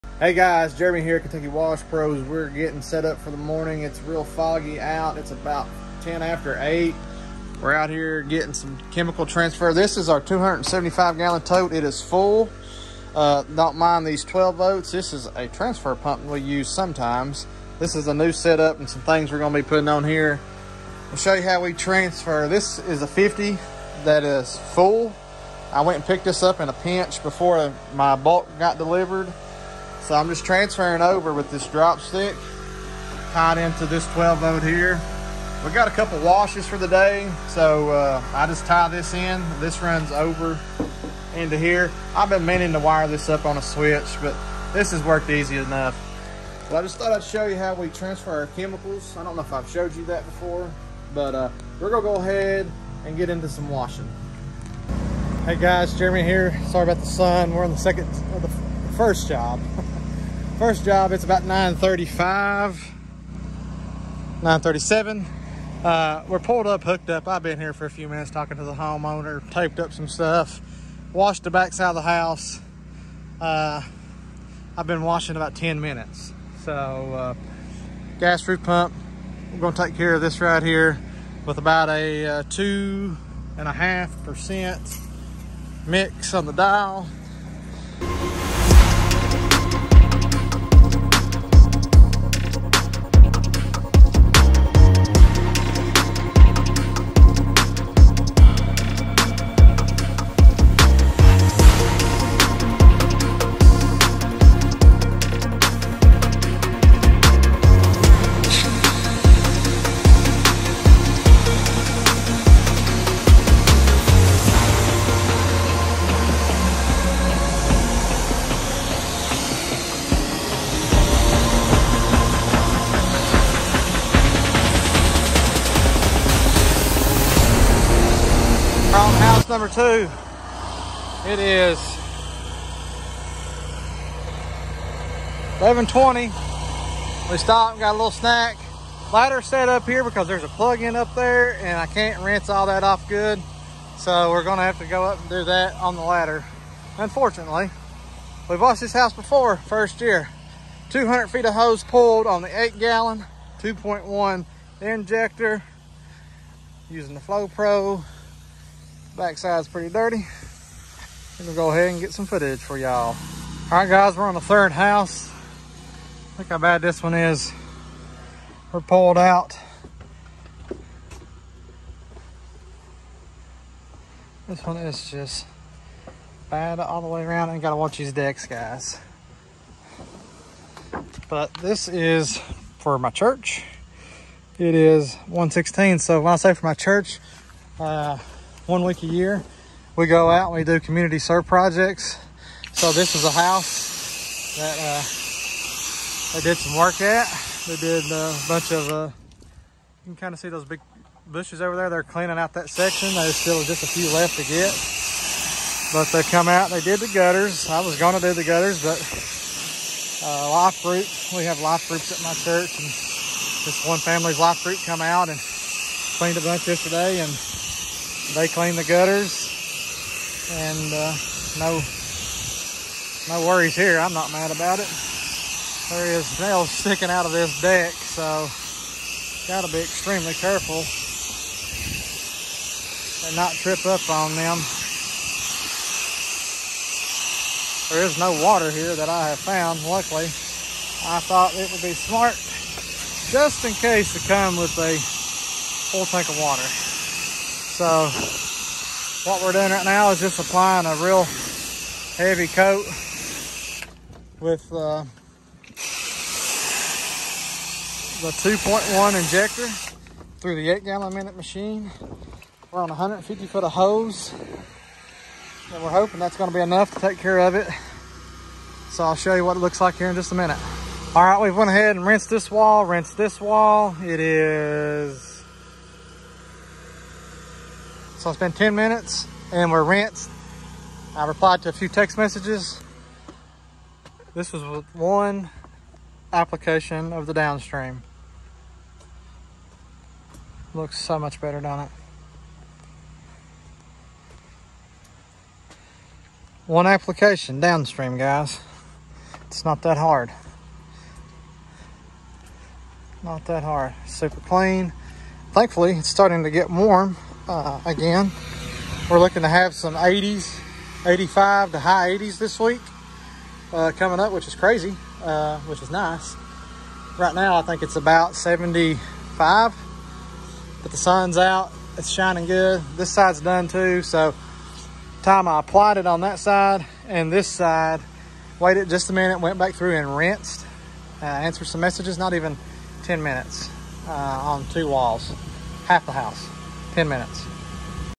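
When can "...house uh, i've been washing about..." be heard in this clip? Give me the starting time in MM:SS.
01:12.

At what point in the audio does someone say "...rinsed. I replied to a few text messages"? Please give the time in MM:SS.
04:39.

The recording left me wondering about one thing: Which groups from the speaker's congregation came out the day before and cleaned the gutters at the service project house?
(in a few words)
life groups.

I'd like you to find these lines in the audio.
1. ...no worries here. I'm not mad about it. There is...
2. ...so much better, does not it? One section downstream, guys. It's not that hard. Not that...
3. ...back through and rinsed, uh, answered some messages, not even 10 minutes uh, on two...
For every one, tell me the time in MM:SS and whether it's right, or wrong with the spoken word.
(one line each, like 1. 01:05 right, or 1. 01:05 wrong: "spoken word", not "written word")
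1. 03:43 right
2. 04:50 wrong: "application", not "section"
3. 05:29 right.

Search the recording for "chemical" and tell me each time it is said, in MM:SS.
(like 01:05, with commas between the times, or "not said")
00:08, 00:48.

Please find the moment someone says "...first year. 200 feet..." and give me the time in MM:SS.
02:29.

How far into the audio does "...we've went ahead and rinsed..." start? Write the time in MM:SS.
04:31.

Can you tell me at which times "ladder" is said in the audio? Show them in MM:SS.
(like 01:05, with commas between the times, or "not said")
02:19, 02:26.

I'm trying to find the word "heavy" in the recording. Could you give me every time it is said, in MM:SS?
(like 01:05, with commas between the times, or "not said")
04:12.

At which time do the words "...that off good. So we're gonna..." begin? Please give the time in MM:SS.
02:22.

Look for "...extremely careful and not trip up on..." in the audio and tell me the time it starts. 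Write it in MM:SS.
03:49.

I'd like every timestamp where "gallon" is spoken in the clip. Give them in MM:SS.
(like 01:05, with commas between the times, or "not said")
00:11, 02:32, 04:20.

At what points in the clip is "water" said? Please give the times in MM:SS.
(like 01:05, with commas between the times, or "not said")
03:58, 04:06.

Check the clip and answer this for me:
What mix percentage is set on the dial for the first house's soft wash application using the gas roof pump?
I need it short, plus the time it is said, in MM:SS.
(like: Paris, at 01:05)
2.5 percent, at 01:22.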